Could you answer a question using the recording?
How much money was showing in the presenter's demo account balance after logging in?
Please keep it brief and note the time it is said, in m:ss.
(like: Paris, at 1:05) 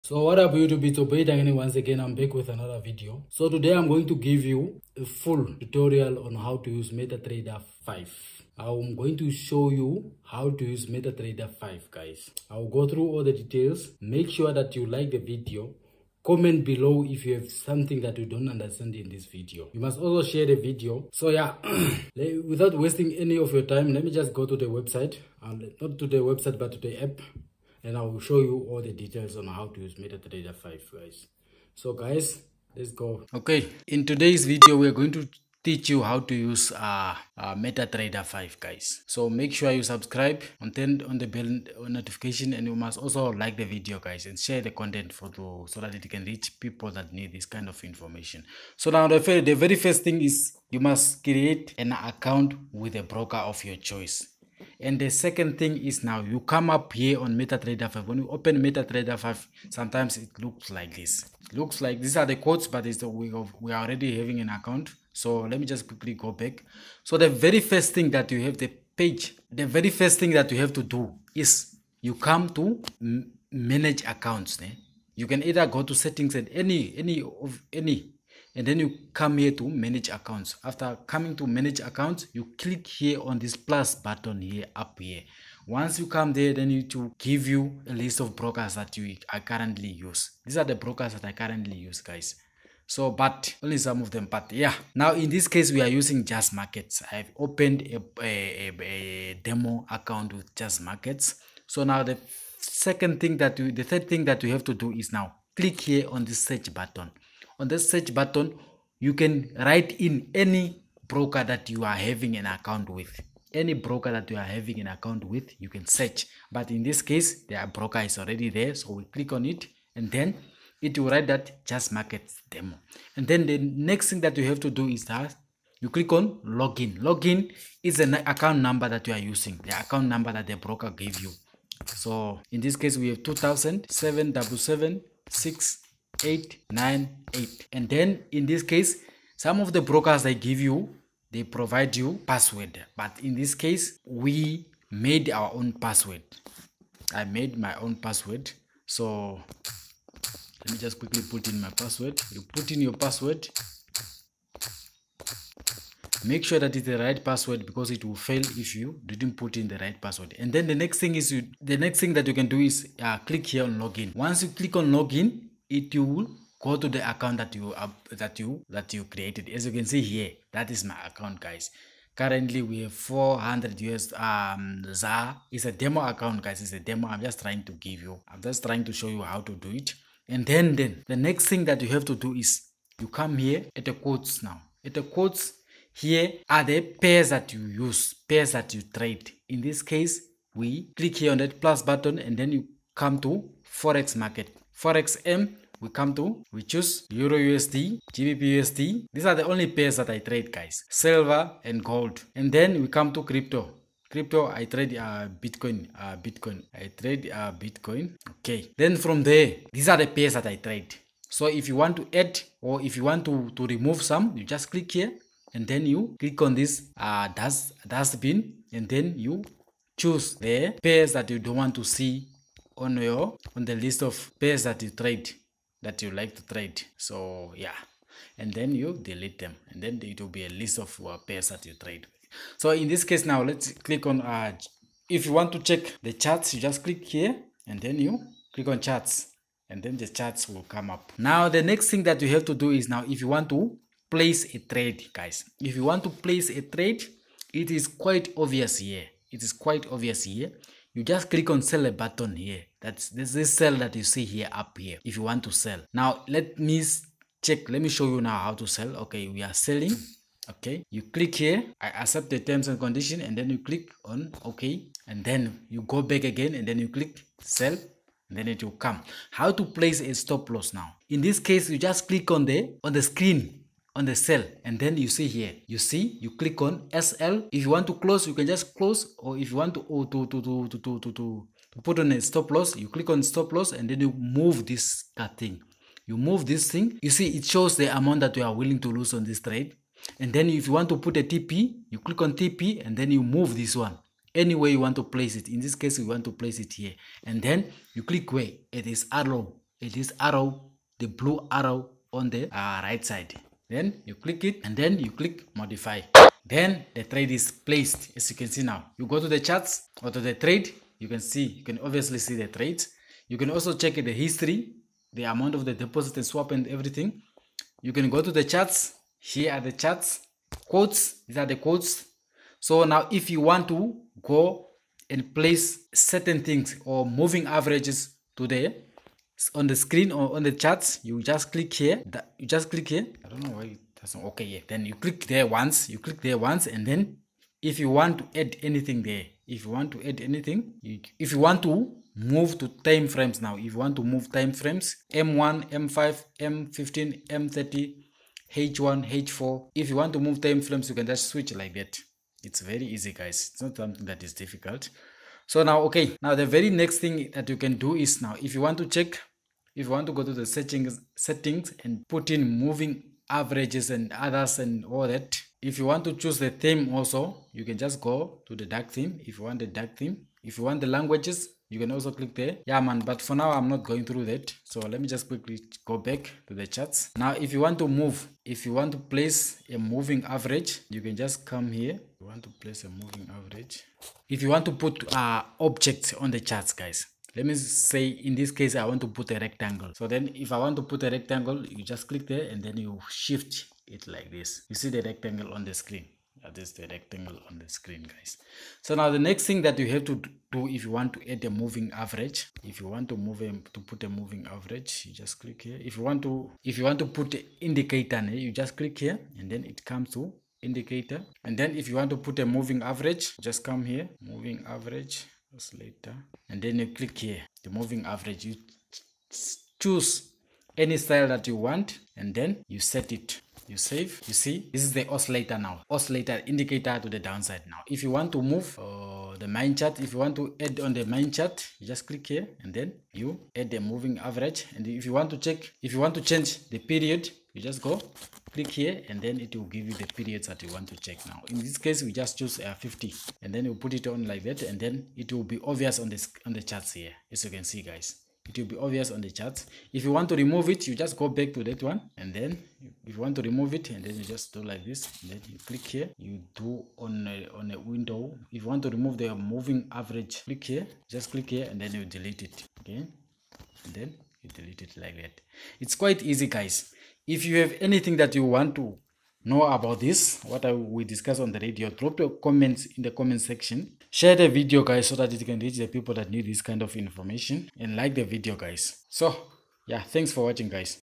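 400, at 2:52.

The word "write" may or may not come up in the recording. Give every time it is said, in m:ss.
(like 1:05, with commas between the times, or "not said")
1:49, 2:01.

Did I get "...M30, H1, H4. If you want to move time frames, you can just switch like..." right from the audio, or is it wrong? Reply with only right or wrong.
right.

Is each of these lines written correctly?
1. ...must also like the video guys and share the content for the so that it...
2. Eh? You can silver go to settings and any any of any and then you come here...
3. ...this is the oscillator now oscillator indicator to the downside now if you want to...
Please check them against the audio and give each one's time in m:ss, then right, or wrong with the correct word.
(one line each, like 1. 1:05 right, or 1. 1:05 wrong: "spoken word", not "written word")
1. 0:42 right
2. 1:14 wrong: "either", not "silver"
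3. 7:04 right.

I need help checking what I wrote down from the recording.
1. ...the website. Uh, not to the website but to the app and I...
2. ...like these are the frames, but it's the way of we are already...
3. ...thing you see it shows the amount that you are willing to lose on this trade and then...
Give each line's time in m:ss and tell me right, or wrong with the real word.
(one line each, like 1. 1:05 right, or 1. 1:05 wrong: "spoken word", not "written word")
1. 0:24 right
2. 1:01 wrong: "quotes", not "frames"
3. 4:46 right.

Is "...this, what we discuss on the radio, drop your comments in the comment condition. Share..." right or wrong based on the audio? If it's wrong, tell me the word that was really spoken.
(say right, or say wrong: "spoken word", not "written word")
wrong: "section", not "condition".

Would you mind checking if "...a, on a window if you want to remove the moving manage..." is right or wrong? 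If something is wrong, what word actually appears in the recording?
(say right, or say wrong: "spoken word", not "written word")
wrong: "average", not "manage".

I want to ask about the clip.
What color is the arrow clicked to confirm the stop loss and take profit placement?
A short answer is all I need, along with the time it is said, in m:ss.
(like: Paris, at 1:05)
blue, at 5:01.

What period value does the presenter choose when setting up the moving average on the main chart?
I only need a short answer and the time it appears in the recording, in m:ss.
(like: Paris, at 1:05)
50, at 7:22.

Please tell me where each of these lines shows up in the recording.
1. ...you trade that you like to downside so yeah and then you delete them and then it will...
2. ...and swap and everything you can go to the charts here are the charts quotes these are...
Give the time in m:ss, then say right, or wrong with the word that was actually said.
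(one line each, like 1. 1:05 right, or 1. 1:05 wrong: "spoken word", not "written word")
1. 3:44 wrong: "trade", not "downside"
2. 5:16 right.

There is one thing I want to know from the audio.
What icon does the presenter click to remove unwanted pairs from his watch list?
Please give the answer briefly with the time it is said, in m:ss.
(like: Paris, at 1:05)
dustbin, at 3:37.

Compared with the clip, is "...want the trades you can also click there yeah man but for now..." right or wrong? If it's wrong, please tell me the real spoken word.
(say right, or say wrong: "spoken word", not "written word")
wrong: "languages", not "trades".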